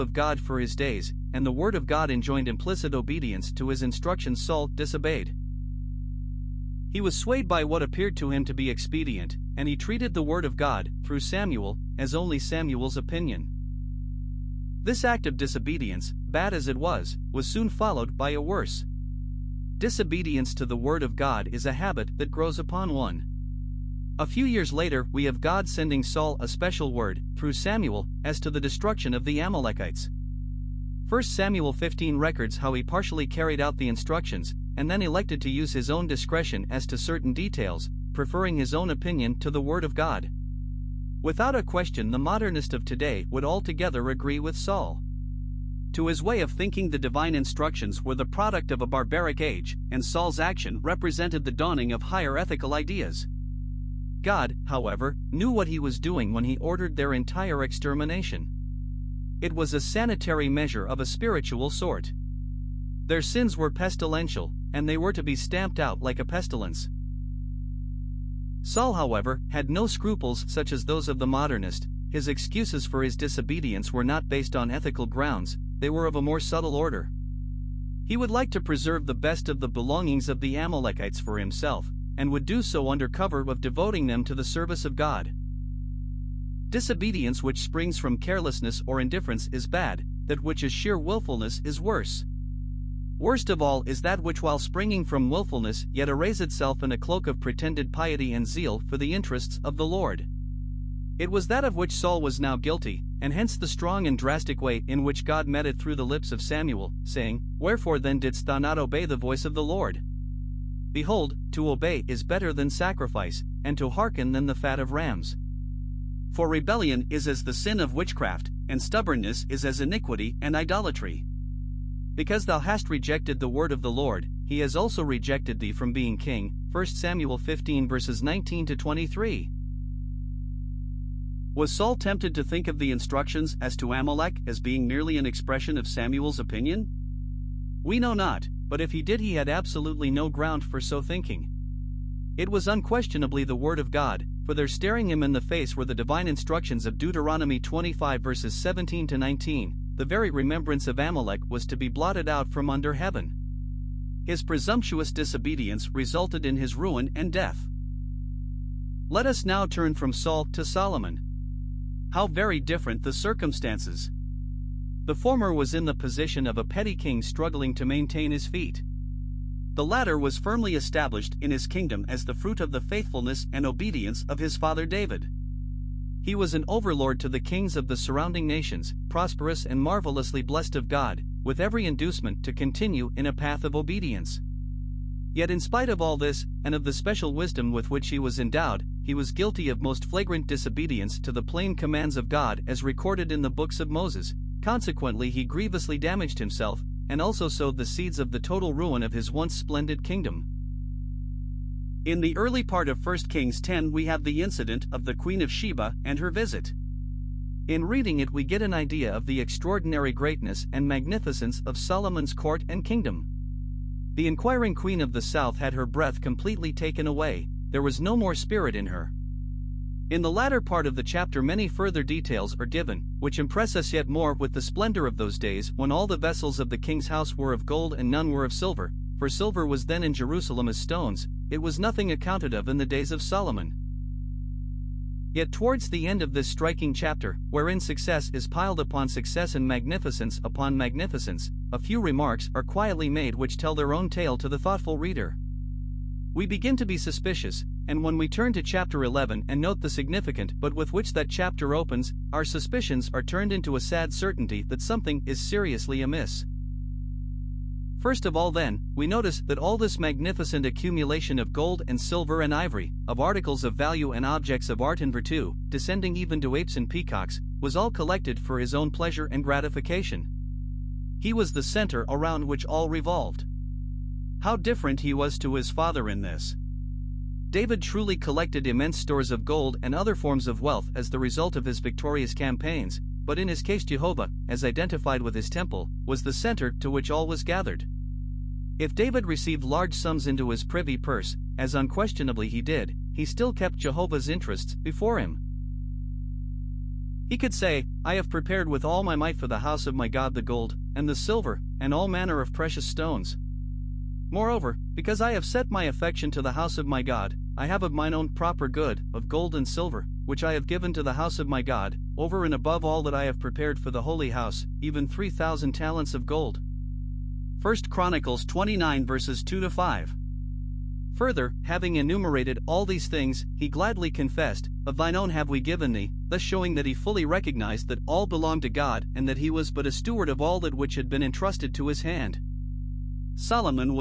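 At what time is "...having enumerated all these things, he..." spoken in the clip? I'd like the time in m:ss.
5:21.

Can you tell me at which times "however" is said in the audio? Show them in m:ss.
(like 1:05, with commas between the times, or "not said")
0:54, 1:08.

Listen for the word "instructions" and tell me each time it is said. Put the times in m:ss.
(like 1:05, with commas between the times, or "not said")
0:03, 0:33, 0:47, 2:12, 2:26.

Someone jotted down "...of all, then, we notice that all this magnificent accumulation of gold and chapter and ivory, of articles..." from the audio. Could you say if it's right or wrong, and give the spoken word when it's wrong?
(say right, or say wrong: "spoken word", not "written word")
wrong: "silver", not "chapter".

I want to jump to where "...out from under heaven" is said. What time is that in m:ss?
2:32.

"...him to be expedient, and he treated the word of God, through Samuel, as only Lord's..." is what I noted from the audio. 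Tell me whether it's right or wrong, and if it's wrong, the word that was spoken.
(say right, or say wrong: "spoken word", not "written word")
wrong: "Samuel", not "Lord".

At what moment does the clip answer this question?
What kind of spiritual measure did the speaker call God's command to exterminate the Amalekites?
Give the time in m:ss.
0:59.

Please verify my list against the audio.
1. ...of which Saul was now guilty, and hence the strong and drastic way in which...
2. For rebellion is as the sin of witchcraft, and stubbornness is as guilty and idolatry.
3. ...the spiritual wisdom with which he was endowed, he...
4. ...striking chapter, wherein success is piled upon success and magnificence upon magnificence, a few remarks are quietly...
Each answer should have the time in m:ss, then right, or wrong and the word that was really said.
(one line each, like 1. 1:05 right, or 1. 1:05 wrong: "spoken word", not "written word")
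1. 1:41 right
2. 1:56 wrong: "iniquity", not "guilty"
3. 3:06 wrong: "special", not "spiritual"
4. 3:56 right.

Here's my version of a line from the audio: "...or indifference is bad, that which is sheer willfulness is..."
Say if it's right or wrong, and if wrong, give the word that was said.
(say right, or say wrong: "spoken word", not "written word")
right.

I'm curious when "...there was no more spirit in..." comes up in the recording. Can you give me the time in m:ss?
3:37.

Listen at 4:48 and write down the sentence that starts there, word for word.
If David received large sums into his privy purse, as unquestionably he did, he still kept Jehovah's interests before him.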